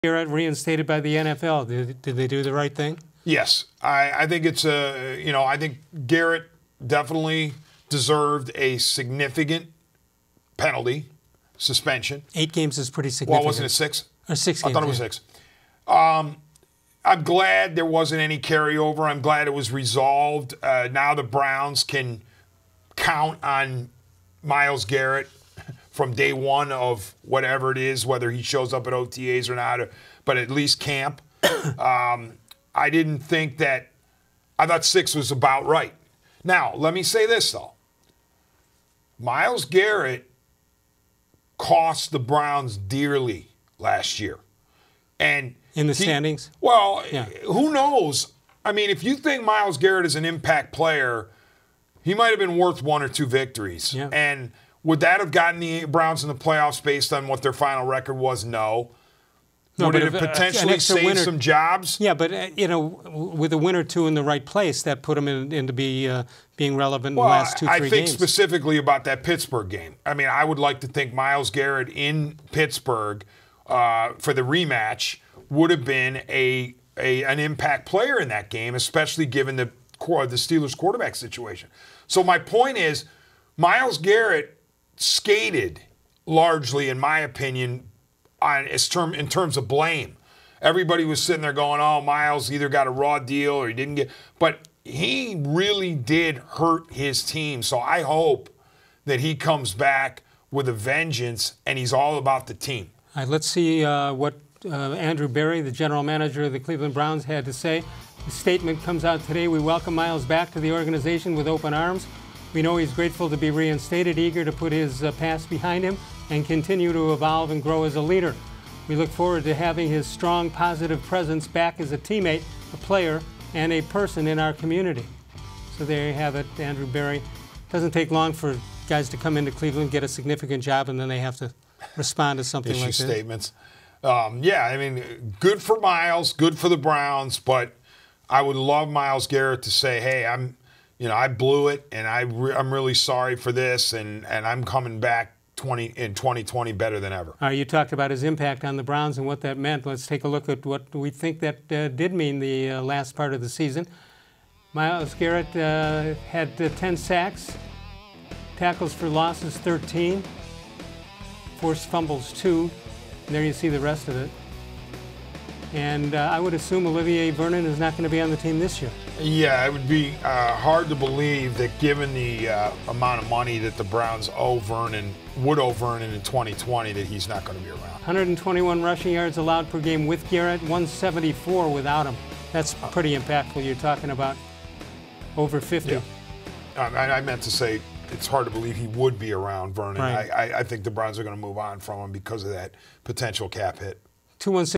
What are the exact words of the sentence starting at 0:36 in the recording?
Now, let me say this though Myles Garrett cost the Browns dearly last year.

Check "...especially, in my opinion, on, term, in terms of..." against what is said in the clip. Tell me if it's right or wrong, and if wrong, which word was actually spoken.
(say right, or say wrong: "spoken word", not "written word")
wrong: "largely", not "especially".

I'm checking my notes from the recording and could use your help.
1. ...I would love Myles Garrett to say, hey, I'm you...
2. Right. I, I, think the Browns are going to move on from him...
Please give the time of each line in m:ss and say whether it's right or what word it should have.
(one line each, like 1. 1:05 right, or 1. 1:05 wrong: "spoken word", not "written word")
1. 2:18 right
2. 3:10 right.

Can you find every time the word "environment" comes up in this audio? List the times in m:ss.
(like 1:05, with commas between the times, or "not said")
not said.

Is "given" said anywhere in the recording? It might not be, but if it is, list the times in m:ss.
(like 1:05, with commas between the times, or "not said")
1:19, 2:51.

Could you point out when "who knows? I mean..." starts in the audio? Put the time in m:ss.
0:47.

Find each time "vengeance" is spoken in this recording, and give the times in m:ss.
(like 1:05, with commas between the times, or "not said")
1:40.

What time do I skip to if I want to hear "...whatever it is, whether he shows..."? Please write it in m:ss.
0:27.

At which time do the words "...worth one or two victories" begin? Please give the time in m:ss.
0:52.